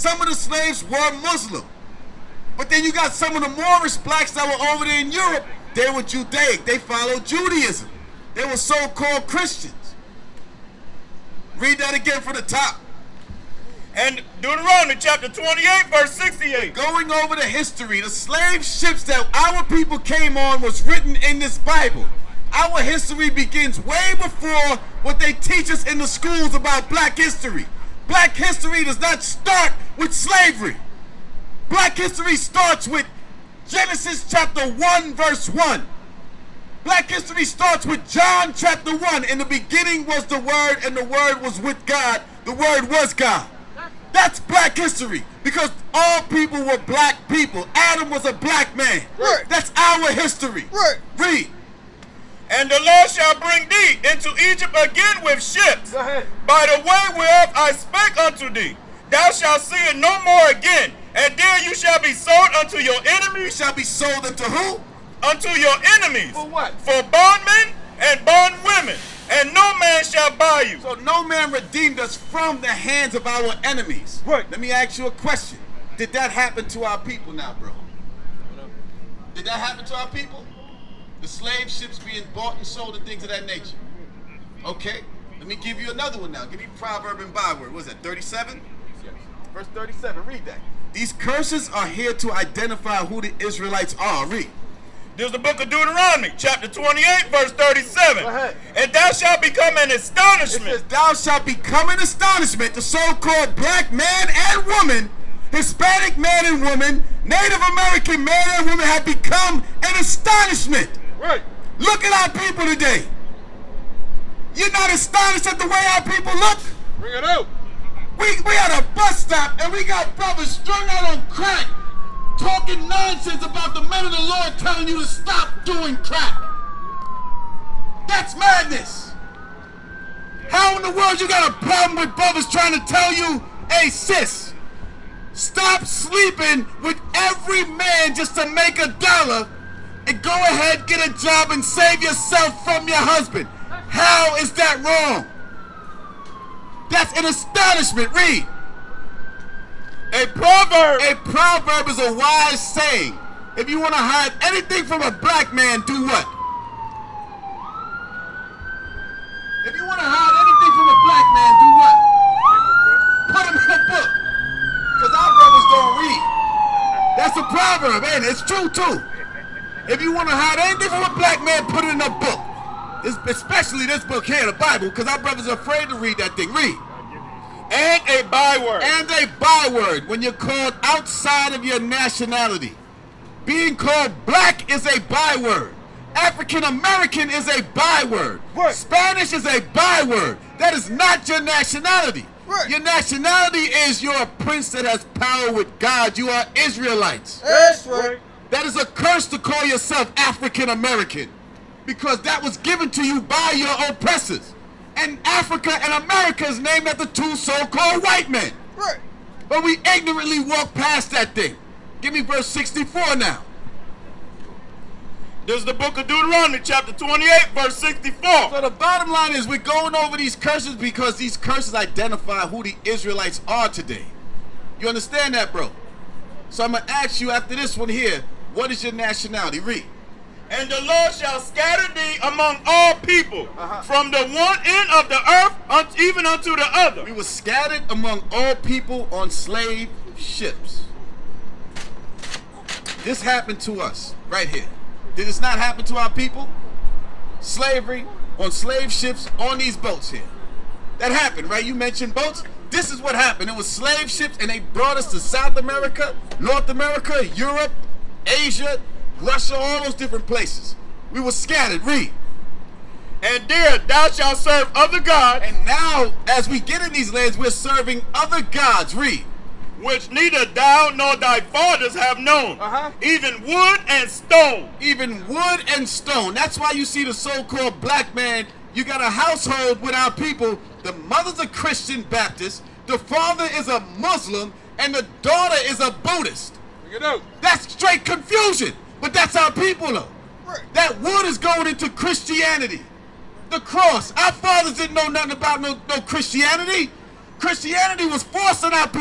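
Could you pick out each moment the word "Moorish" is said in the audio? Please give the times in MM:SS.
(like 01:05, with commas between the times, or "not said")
00:03.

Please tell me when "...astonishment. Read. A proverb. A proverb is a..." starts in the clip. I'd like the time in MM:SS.
02:27.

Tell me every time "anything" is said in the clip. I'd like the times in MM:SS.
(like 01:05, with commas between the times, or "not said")
02:34, 02:40, 02:50.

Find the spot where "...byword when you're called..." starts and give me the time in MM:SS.
02:59.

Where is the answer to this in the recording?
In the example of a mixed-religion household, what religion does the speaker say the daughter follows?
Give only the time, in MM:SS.
04:45.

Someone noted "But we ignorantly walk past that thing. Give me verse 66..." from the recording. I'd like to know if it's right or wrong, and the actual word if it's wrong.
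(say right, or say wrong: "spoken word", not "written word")
wrong: "64", not "66".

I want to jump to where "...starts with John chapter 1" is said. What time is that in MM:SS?
00:37.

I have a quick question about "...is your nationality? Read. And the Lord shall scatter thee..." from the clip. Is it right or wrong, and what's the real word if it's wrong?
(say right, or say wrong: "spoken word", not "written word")
right.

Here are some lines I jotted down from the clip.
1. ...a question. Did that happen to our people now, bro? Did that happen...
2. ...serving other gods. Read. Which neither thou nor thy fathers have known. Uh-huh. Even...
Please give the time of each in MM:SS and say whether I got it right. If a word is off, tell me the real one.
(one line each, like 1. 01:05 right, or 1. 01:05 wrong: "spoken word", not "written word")
1. 01:15 right
2. 04:27 right.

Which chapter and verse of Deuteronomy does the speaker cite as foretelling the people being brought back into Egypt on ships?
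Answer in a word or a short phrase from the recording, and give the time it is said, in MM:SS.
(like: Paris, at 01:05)
Chapter 28, verse 68, at 00:14.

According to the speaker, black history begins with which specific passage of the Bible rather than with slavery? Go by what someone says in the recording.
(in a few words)
Genesis 1:1.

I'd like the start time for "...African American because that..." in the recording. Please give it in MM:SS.
03:20.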